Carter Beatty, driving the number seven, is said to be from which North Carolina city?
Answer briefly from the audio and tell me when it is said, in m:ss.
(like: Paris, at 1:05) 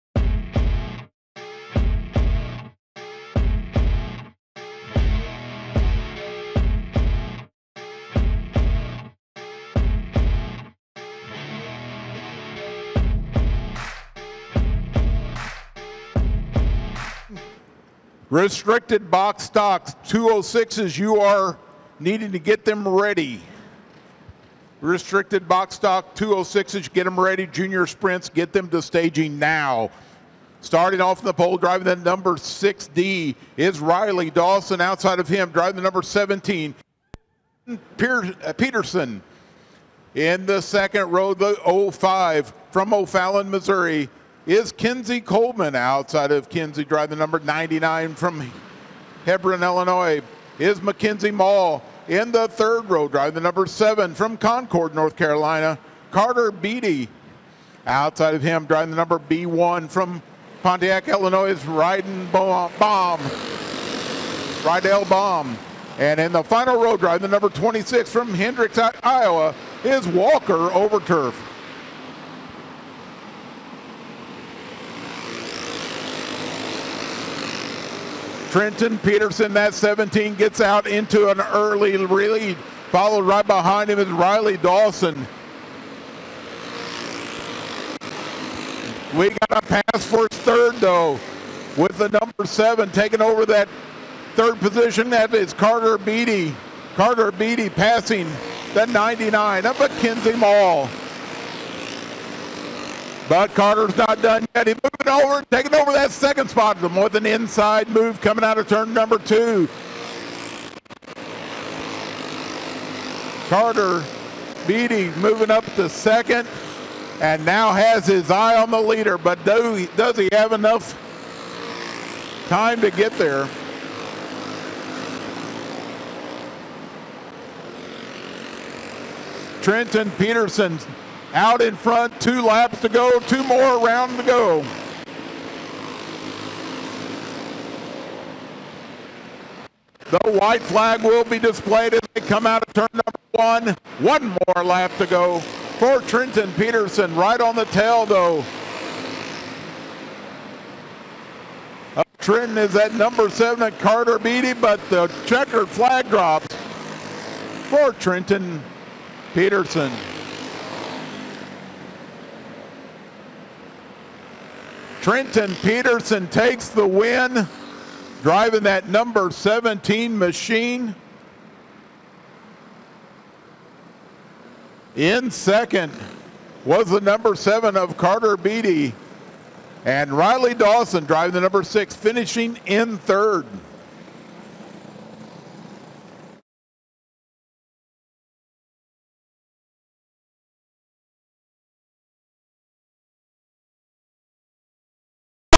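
Concord, at 0:54.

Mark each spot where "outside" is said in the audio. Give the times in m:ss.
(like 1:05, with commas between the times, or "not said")
0:34, 0:45, 0:57.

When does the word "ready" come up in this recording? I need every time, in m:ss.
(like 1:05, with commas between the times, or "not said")
0:22, 0:27.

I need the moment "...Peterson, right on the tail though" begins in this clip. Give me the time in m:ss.
2:26.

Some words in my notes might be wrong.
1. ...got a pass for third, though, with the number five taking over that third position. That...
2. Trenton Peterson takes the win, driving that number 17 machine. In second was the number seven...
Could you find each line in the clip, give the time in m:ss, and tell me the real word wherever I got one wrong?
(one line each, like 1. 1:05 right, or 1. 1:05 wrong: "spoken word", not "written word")
1. 1:29 wrong: "seven", not "five"
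2. 2:45 right.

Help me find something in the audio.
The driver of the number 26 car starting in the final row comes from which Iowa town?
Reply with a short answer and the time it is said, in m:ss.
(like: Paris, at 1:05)
Hendricks, at 1:08.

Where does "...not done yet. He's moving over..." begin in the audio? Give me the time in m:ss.
1:43.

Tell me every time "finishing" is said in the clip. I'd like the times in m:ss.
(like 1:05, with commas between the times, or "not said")
3:01.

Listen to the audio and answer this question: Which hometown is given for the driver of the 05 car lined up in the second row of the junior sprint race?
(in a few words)
O'Fallon, Missouri.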